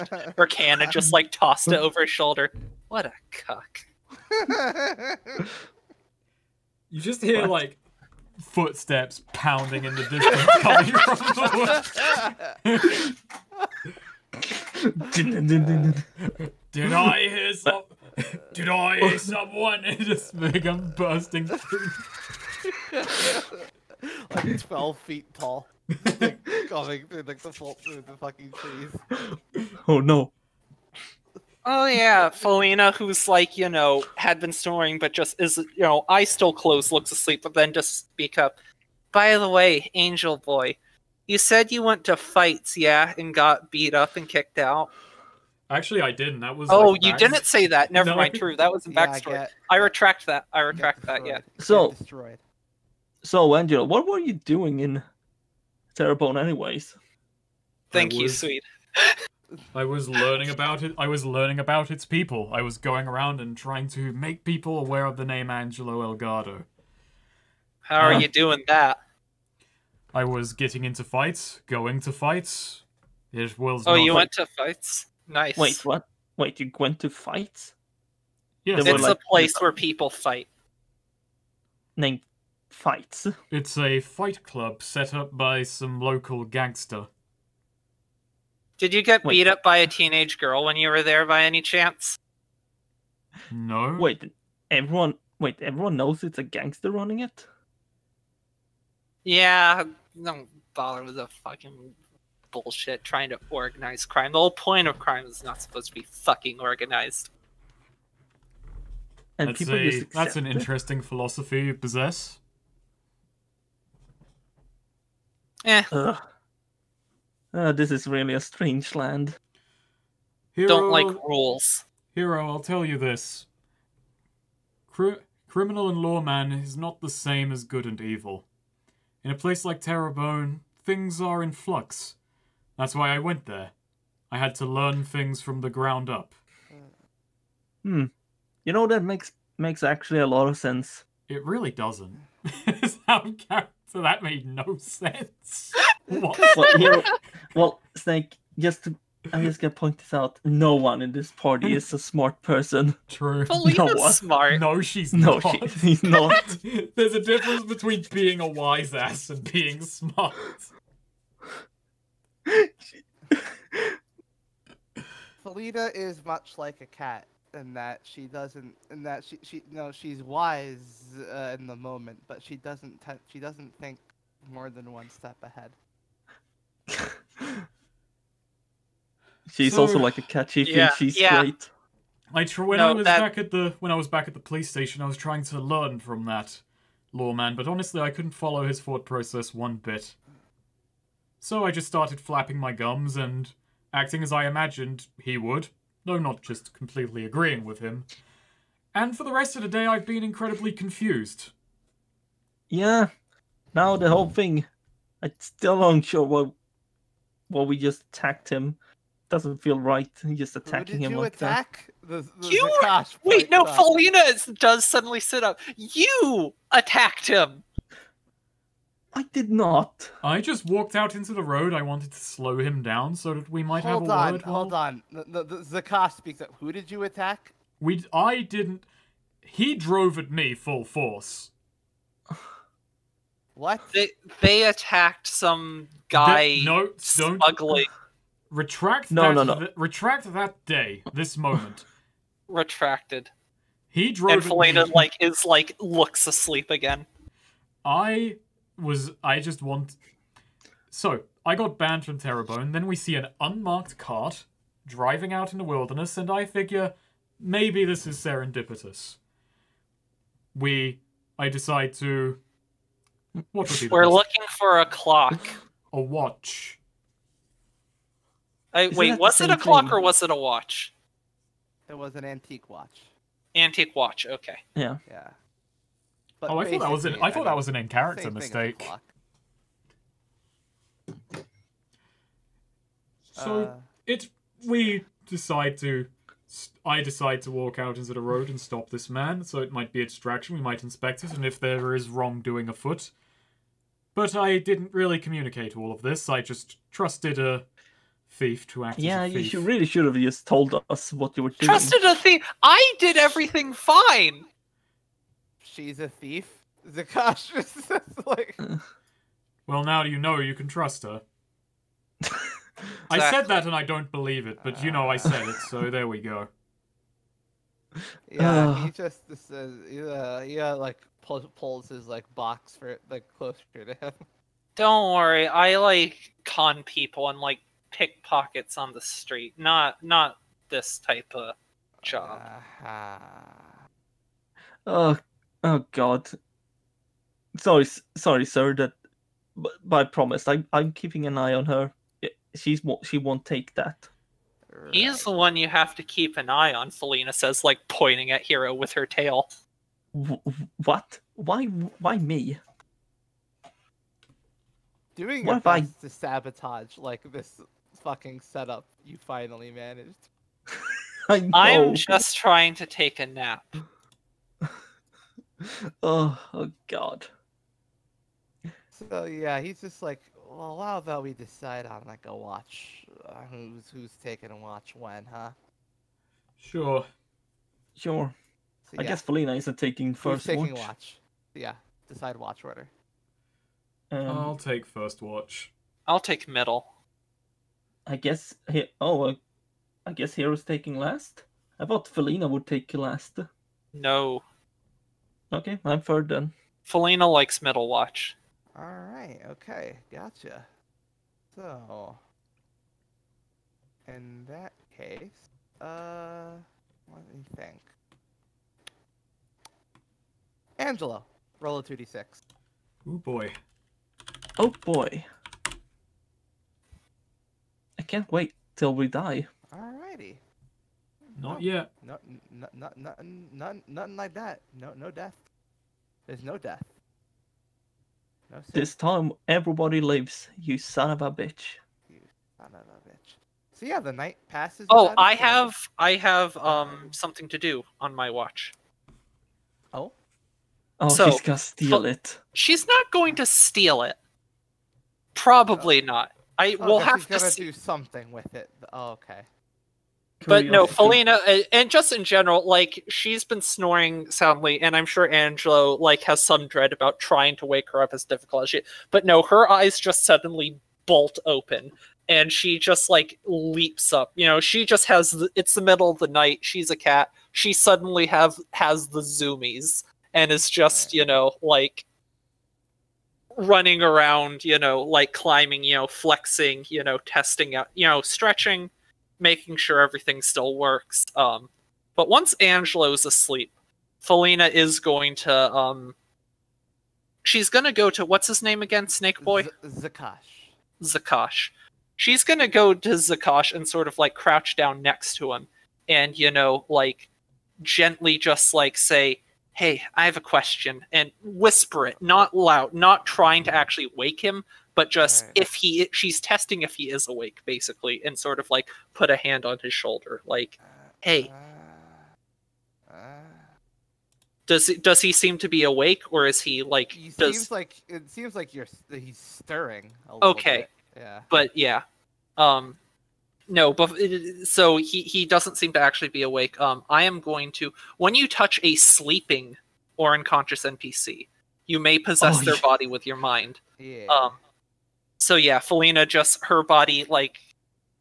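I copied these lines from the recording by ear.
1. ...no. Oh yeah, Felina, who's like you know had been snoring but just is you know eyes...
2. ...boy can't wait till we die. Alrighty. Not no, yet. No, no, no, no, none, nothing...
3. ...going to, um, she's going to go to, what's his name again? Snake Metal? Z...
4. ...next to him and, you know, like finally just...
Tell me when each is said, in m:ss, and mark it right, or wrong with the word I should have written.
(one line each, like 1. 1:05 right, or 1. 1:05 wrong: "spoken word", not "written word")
1. 0:30 right
2. 6:54 right
3. 8:05 wrong: "Boy", not "Metal"
4. 8:15 wrong: "gently", not "finally".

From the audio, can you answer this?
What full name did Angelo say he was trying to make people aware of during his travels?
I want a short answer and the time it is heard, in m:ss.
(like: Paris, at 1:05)
Angelo Elgardo, at 1:05.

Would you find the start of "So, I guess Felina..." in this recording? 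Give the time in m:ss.
6:18.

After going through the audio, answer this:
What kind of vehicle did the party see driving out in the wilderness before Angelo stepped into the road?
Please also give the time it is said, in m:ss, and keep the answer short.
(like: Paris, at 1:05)
Unmarked cart, at 4:13.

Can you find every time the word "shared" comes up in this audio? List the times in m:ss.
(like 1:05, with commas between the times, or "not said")
not said.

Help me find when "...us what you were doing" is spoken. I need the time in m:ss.
5:00.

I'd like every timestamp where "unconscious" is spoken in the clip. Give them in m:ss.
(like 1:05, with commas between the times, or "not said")
8:50.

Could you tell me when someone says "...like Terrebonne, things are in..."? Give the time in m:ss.
2:09.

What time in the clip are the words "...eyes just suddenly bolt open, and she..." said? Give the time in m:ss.
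7:39.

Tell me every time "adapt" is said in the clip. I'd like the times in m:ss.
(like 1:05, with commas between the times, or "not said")
not said.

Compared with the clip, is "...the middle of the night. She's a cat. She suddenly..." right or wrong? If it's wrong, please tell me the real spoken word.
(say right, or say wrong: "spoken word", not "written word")
right.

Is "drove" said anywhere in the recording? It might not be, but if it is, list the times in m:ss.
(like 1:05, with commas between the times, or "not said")
3:49, 4:04.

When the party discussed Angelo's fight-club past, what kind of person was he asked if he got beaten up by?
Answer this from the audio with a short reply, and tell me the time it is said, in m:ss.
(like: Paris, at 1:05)
A teenage girl, at 1:29.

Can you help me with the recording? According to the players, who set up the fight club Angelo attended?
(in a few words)
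Some local gangster.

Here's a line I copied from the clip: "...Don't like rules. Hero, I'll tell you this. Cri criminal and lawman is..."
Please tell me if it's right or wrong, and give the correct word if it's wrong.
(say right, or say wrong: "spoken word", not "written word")
right.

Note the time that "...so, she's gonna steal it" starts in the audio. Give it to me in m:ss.
7:21.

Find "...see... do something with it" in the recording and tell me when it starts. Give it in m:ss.
7:27.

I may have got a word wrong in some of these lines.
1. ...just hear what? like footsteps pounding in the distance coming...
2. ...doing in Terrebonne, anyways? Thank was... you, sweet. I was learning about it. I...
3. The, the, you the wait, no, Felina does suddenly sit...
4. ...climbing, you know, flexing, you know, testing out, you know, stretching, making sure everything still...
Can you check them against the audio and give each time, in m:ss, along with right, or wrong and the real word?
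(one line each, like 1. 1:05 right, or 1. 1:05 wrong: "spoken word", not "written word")
1. 0:07 right
2. 0:54 right
3. 3:32 right
4. 7:55 right.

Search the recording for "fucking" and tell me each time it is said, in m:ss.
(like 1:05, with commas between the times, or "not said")
0:28, 1:41, 1:46, 5:58.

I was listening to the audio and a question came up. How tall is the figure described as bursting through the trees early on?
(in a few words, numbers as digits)
12 feet.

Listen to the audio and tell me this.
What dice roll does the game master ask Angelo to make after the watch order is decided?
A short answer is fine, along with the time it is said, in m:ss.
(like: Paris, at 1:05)
2d6, at 6:51.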